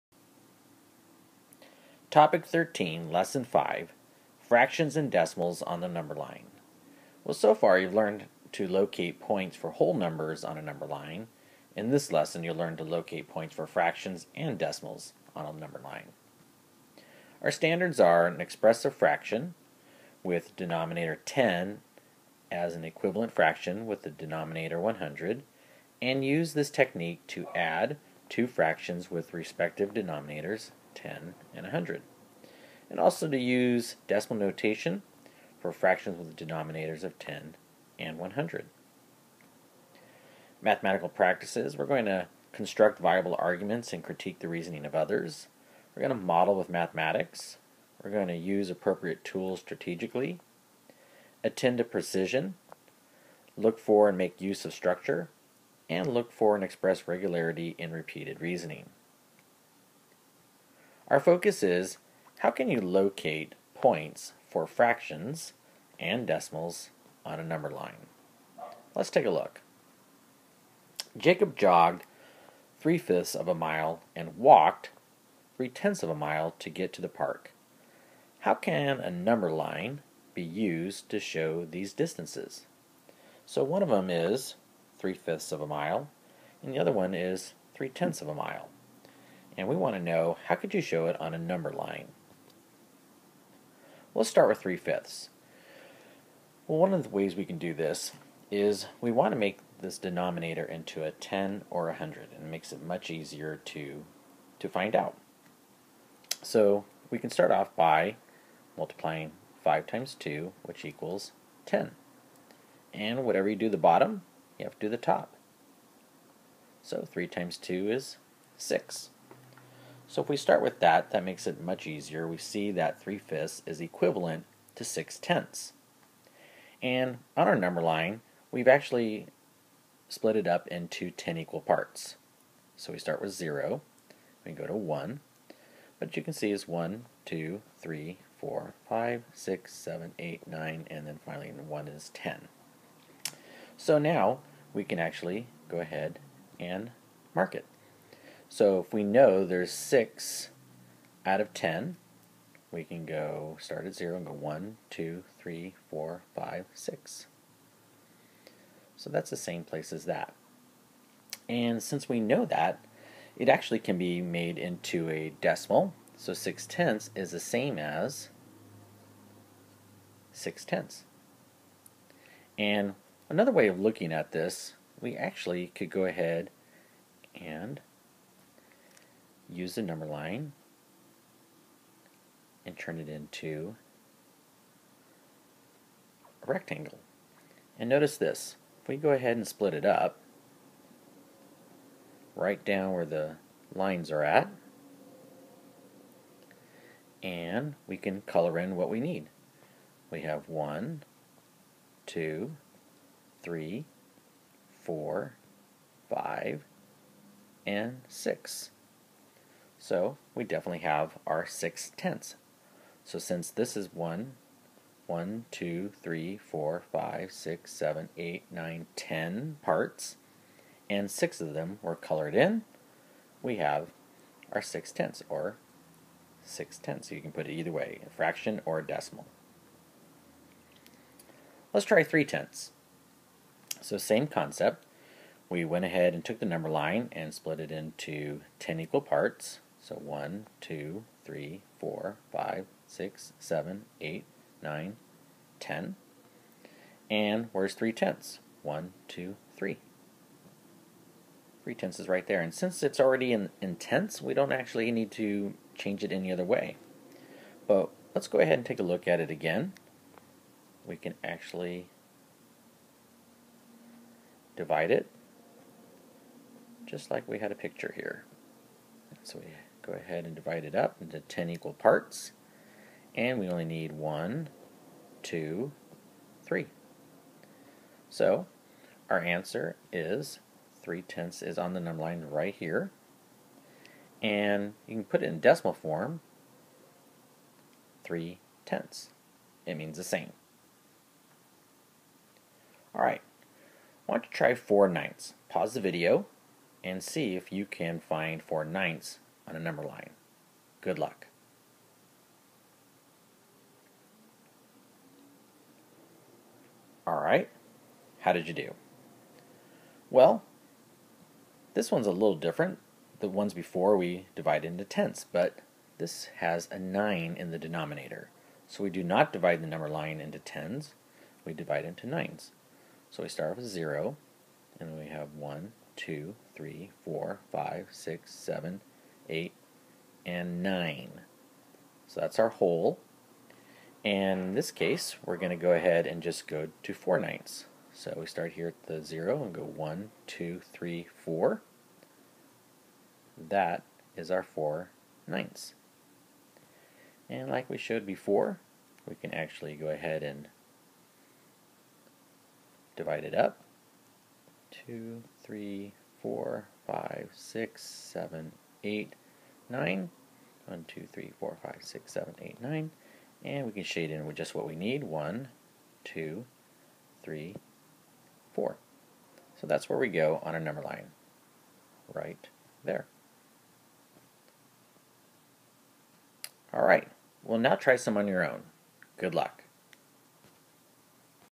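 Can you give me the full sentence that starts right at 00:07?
Well, so far you've learned to locate points for whole numbers on a number line.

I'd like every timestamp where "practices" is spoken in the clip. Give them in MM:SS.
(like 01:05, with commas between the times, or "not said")
00:41.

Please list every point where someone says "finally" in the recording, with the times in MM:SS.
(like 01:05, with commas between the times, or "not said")
02:21.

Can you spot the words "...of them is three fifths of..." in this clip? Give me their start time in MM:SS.
01:23.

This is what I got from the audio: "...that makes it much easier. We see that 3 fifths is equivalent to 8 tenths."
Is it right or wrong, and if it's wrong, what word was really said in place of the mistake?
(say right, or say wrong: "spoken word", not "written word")
wrong: "6", not "8".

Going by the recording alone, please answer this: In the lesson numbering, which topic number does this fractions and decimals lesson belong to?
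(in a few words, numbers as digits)
13.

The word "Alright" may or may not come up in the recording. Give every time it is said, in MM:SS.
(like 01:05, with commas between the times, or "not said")
04:52, 05:07.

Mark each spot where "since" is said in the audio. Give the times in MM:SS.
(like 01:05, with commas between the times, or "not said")
02:41, 03:33, 04:12.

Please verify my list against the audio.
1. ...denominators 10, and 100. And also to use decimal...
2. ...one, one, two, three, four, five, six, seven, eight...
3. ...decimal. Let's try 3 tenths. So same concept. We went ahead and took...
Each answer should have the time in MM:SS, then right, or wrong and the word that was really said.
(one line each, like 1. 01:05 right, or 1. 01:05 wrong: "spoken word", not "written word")
1. 00:29 right
2. 03:33 right
3. 03:48 right.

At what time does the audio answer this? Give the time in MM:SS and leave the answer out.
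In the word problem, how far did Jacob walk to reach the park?
01:14.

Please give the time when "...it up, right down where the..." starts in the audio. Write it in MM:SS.
03:09.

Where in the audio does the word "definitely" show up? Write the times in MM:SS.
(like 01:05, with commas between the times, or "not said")
03:30.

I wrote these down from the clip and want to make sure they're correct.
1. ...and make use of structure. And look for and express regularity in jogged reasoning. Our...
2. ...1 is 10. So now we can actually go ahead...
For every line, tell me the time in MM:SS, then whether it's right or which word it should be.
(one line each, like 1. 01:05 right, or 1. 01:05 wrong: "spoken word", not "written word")
1. 00:54 wrong: "repeated", not "jogged"
2. 02:21 right.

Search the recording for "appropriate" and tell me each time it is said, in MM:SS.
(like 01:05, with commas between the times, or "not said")
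00:48.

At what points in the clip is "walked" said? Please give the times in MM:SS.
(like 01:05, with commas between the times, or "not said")
01:14.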